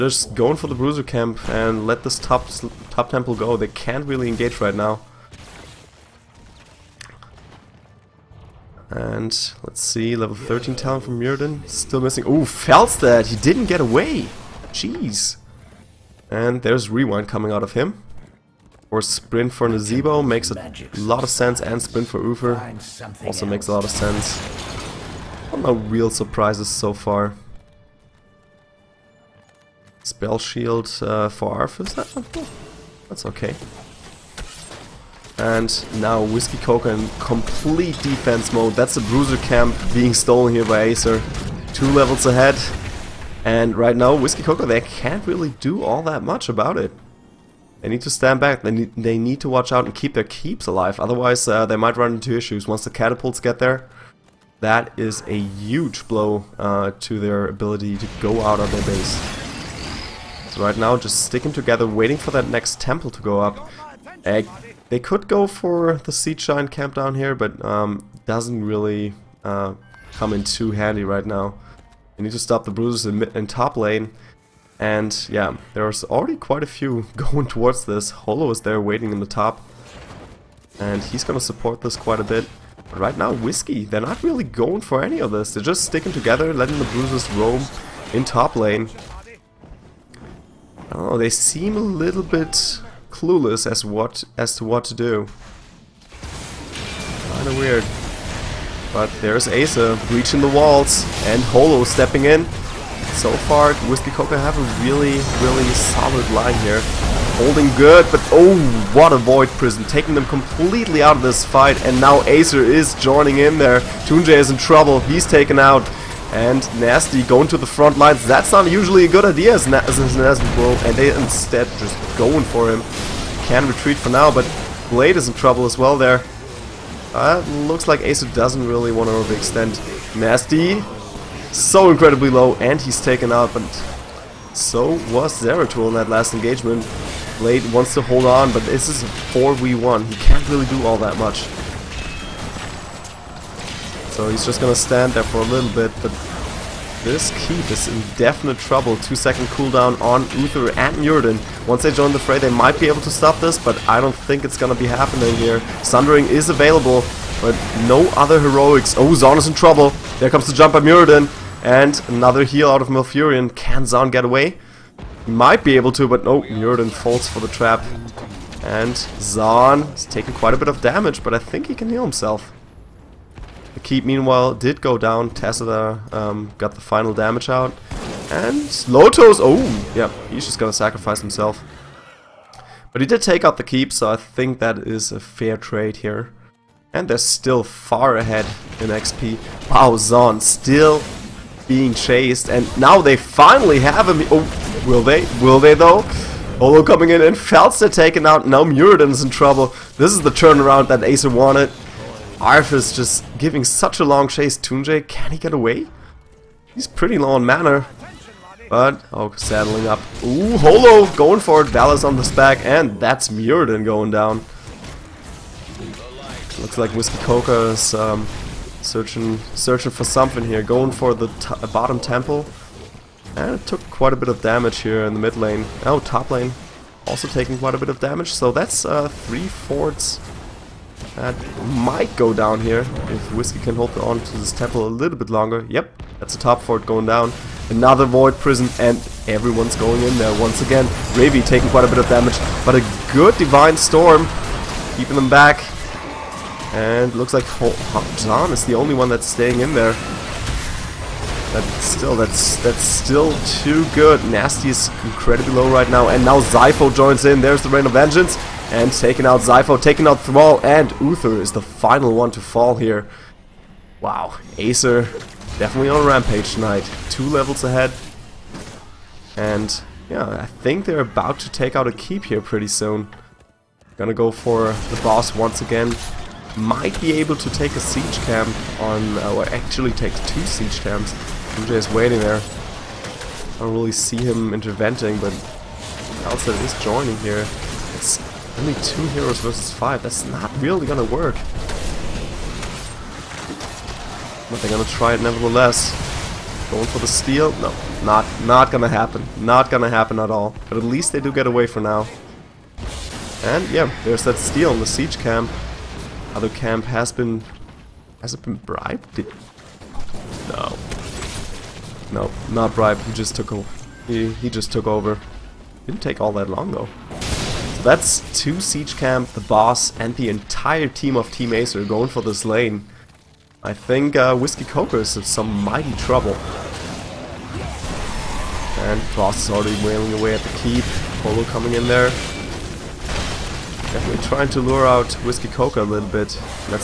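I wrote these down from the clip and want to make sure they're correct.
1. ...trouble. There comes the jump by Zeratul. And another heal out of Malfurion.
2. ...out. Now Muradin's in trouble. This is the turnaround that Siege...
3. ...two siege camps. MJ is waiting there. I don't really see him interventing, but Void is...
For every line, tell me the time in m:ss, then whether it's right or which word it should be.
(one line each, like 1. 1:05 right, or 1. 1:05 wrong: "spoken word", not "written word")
1. 2:39 wrong: "Muradin", not "Zeratul"
2. 3:18 wrong: "Acer", not "Siege"
3. 4:40 wrong: "Elsa", not "Void".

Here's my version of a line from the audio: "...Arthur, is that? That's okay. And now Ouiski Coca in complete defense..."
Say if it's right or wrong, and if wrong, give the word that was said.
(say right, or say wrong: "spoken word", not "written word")
right.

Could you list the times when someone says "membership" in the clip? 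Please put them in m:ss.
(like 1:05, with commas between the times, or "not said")
not said.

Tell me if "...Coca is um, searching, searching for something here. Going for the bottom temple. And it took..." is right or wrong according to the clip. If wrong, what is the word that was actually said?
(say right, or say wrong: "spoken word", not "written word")
right.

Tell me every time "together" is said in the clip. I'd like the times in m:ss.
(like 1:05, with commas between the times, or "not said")
1:01, 1:26.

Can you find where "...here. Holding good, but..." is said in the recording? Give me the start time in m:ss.
1:46.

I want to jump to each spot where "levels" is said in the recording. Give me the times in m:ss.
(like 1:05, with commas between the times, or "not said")
0:10, 0:41, 4:27.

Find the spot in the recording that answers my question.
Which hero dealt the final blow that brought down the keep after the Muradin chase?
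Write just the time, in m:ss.
2:55.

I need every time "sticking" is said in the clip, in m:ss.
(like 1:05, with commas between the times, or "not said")
1:01, 1:25.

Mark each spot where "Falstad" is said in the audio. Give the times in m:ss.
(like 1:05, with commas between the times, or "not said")
0:12, 3:17.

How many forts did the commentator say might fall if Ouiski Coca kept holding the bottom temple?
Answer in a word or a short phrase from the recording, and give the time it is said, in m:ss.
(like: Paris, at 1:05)
3, at 3:49.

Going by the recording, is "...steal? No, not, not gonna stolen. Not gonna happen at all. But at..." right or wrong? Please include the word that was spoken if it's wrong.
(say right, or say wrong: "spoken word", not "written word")
wrong: "happen", not "stolen".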